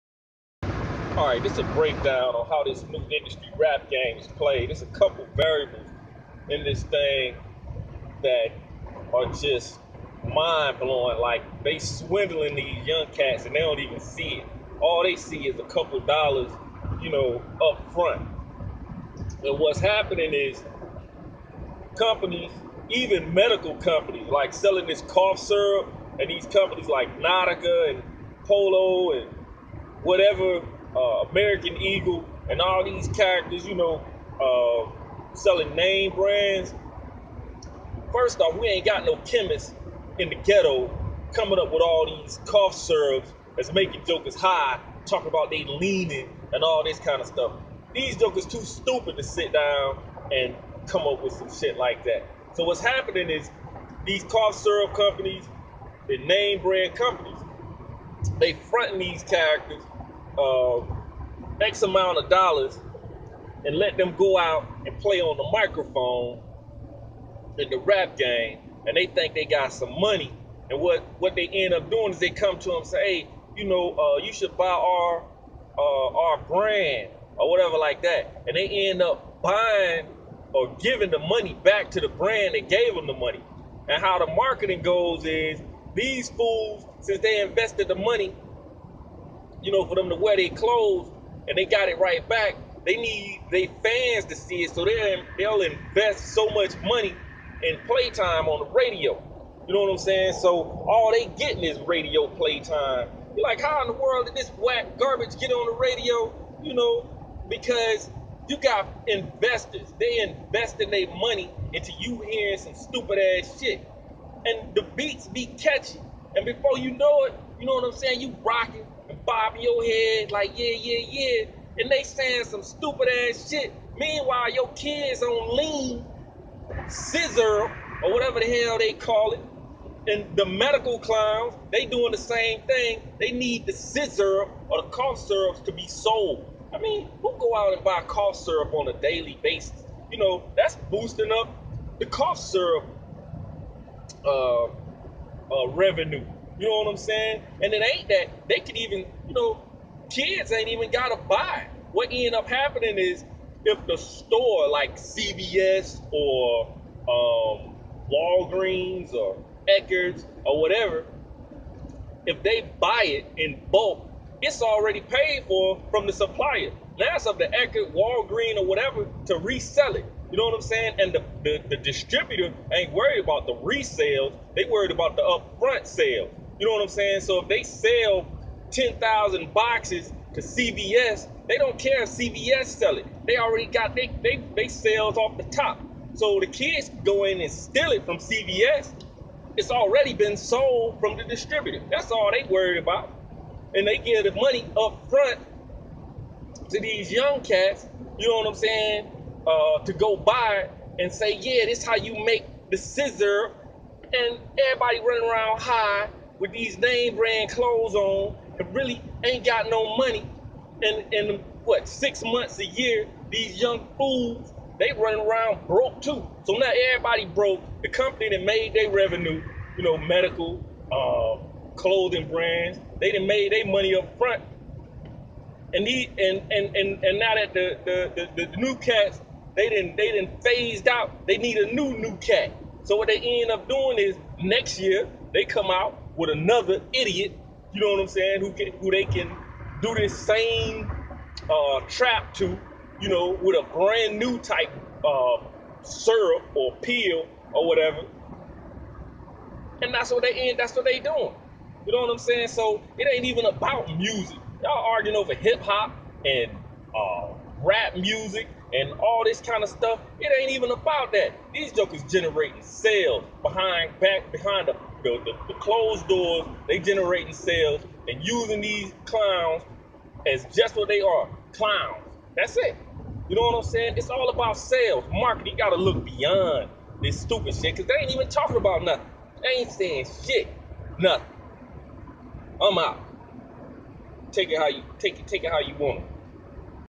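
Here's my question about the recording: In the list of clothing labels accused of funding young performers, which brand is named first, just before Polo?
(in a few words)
Nautica.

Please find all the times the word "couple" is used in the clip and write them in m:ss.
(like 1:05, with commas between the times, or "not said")
0:04, 0:15.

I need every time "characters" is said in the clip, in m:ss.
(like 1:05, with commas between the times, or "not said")
0:33, 0:59.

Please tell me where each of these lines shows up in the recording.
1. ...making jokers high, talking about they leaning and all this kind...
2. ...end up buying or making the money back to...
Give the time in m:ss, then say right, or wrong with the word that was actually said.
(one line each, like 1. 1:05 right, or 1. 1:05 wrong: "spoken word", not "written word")
1. 0:43 right
2. 1:18 wrong: "giving", not "making".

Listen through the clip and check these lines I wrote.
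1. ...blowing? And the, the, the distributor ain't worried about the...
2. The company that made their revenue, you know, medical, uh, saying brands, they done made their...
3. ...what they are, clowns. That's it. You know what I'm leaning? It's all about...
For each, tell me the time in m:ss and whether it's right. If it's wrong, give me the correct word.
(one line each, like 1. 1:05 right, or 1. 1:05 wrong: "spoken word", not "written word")
1. 2:50 wrong: "saying", not "blowing"
2. 3:37 wrong: "clothing", not "saying"
3. 4:30 wrong: "saying", not "leaning".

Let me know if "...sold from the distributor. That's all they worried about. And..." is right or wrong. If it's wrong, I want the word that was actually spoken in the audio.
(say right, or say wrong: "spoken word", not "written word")
right.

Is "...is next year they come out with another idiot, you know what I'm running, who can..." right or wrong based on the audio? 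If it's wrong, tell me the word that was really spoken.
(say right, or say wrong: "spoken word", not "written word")
wrong: "saying", not "running".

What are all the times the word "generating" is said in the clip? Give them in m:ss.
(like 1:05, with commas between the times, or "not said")
4:22, 4:26.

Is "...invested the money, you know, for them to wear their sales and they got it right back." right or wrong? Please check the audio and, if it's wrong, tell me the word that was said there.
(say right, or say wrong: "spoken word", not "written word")
wrong: "clothes", not "sales".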